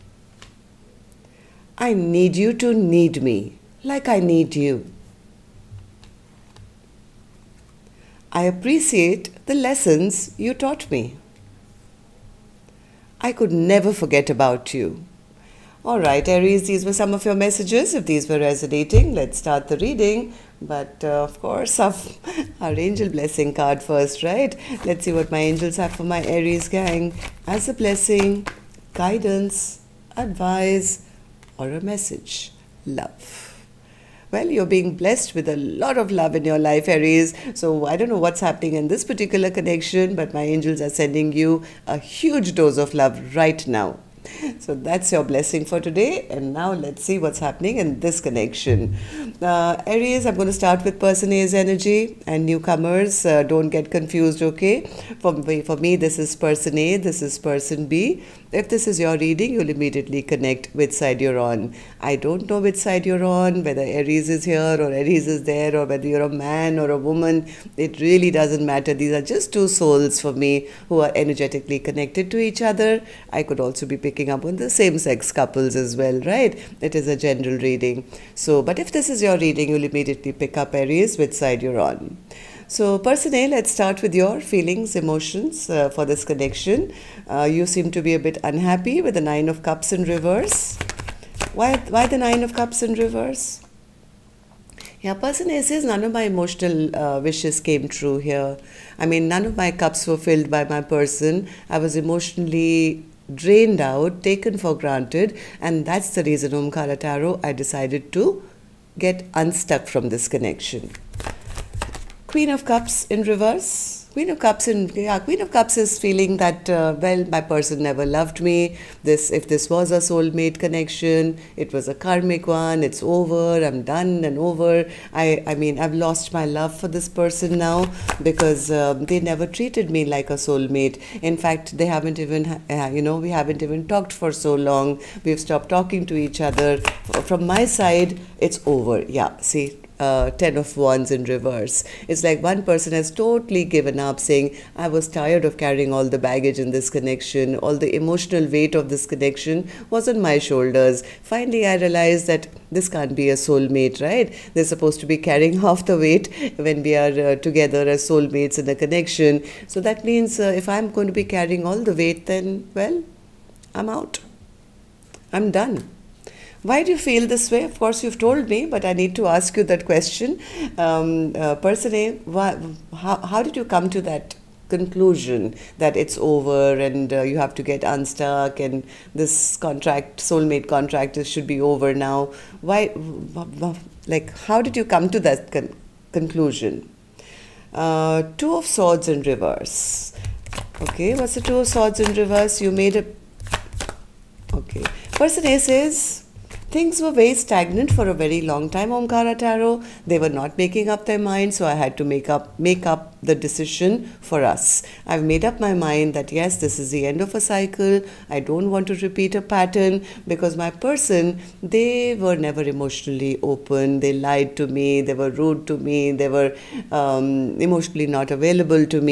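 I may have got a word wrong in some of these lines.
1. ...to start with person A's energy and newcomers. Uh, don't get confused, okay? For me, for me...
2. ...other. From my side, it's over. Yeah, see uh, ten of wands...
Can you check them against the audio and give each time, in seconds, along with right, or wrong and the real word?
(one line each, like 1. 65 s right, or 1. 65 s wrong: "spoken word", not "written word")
1. 50 s right
2. 136 s right.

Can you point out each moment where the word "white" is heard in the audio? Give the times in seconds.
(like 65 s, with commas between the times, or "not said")
not said.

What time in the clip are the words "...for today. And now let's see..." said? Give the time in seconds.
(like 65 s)
45 s.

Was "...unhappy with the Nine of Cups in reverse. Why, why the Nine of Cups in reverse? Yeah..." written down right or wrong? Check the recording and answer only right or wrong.
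right.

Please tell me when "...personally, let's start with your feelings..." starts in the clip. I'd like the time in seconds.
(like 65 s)
82 s.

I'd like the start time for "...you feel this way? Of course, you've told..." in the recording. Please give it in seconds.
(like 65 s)
166 s.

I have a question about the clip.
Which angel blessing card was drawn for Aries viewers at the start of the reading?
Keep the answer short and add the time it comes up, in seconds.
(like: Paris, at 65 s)
Love well, at 32 s.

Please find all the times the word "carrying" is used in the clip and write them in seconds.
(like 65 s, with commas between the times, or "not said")
145 s, 155 s, 161 s.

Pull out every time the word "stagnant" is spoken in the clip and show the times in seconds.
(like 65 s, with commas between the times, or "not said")
197 s.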